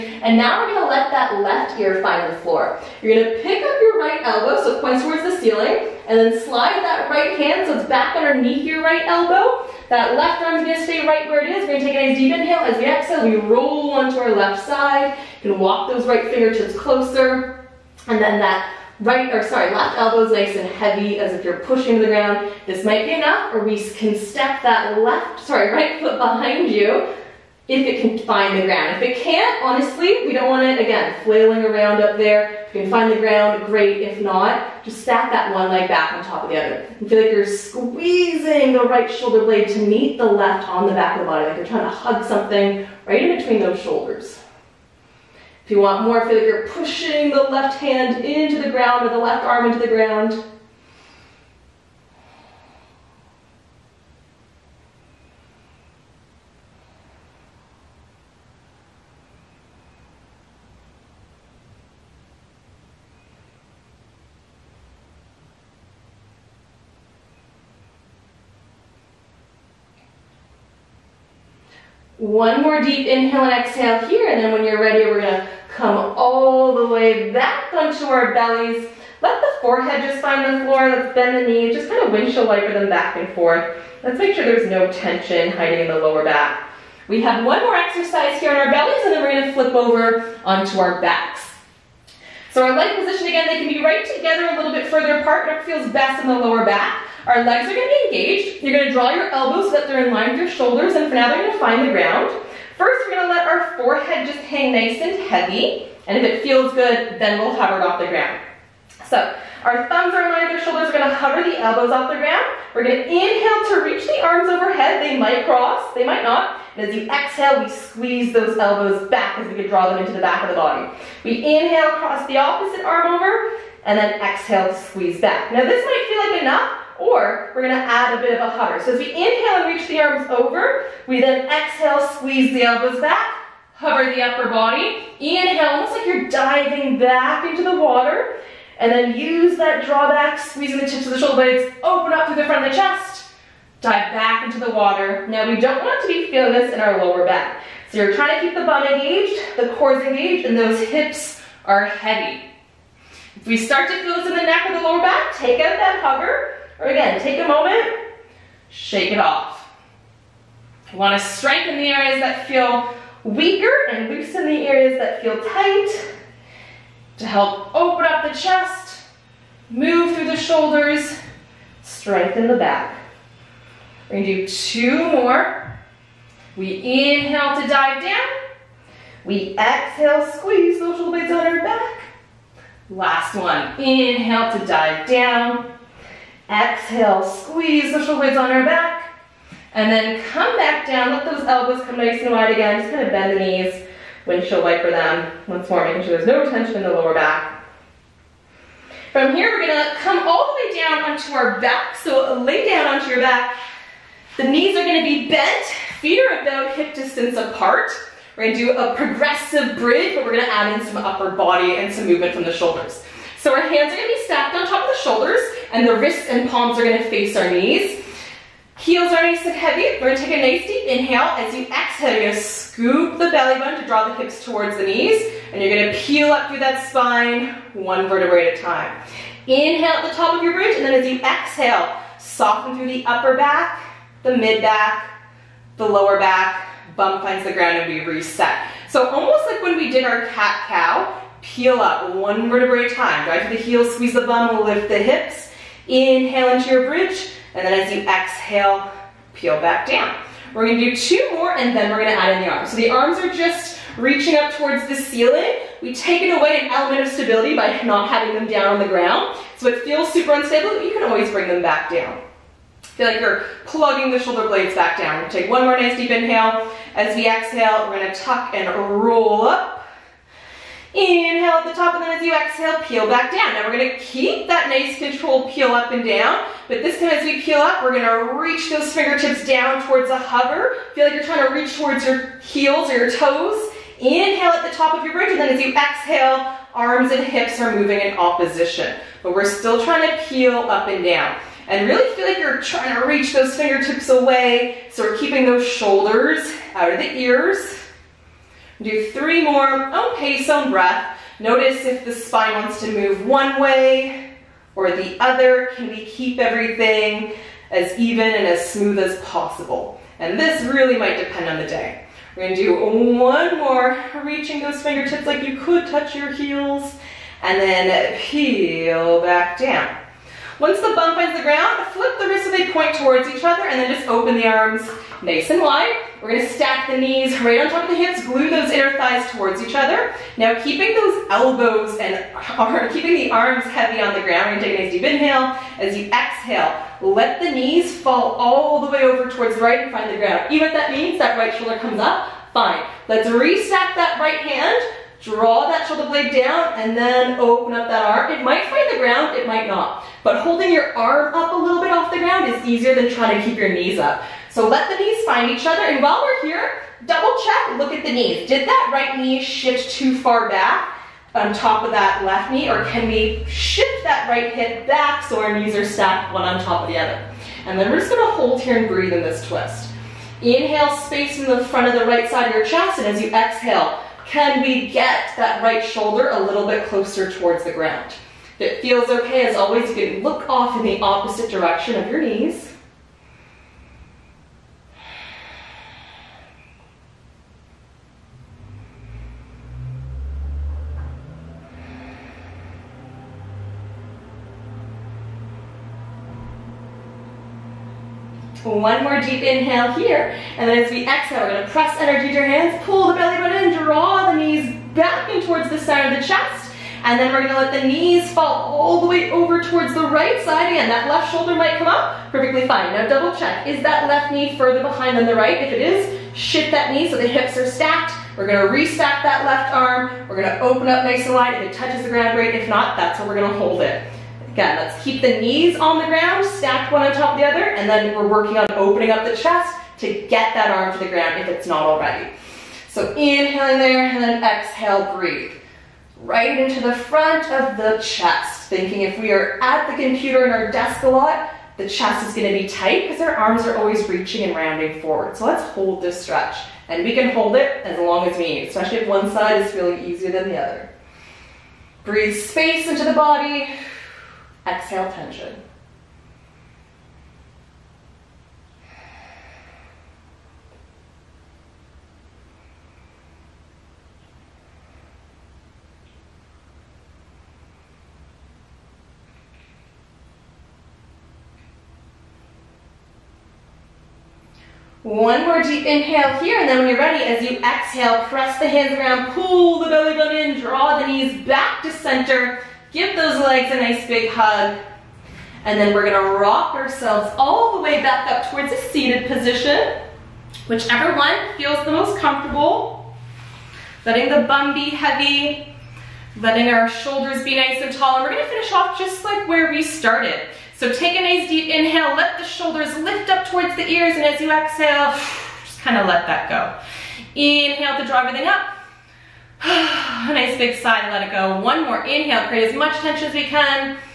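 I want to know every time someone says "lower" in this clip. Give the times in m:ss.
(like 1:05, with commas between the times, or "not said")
1:25, 1:36, 2:27, 2:34, 3:16, 3:55.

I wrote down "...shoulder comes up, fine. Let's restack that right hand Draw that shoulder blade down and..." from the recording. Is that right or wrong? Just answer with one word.
right.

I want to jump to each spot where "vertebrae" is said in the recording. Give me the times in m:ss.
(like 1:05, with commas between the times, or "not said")
3:48, 4:02.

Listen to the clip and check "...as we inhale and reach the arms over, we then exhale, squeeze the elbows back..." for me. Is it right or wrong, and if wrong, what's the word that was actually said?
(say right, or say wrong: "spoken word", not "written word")
right.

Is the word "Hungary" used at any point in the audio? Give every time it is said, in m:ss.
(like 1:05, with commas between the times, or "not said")
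not said.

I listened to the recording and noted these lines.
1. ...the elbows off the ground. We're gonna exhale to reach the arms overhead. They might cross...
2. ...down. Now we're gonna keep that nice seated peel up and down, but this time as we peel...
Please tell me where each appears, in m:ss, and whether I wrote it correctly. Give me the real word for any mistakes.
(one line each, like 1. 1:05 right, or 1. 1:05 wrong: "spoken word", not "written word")
1. 1:51 wrong: "inhale", not "exhale"
2. 4:33 wrong: "controlled", not "seated".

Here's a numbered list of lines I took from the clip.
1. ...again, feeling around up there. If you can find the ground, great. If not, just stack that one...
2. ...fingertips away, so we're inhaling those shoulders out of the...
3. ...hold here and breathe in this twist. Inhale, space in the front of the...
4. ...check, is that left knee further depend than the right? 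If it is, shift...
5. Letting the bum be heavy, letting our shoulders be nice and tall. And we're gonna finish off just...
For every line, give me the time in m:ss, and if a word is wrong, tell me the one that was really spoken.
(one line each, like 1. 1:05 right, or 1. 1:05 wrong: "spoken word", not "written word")
1. 0:30 wrong: "flailing", not "feeling"
2. 4:53 wrong: "keeping", not "inhaling"
3. 6:08 right
4. 6:53 wrong: "behind", not "depend"
5. 8:14 right.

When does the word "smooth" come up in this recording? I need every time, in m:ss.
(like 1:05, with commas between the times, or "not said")
5:08.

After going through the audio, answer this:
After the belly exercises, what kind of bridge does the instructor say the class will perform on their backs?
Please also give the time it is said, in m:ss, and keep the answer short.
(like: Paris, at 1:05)
Progressive bridge, at 3:28.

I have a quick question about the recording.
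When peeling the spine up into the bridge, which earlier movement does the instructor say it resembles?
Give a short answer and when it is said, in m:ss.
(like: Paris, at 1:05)
Cat-cow, at 4:00.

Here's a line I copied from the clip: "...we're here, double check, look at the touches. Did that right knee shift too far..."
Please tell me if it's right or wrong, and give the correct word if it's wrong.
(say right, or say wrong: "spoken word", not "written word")
wrong: "knees", not "touches".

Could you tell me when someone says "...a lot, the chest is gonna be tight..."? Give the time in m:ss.
7:21.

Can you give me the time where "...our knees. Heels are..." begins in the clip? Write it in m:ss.
3:37.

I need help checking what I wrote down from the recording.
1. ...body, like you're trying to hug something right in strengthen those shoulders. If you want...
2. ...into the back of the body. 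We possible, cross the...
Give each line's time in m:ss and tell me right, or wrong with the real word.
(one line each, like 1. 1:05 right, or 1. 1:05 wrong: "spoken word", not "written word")
1. 0:41 wrong: "between", not "strengthen"
2. 1:59 wrong: "inhale", not "possible".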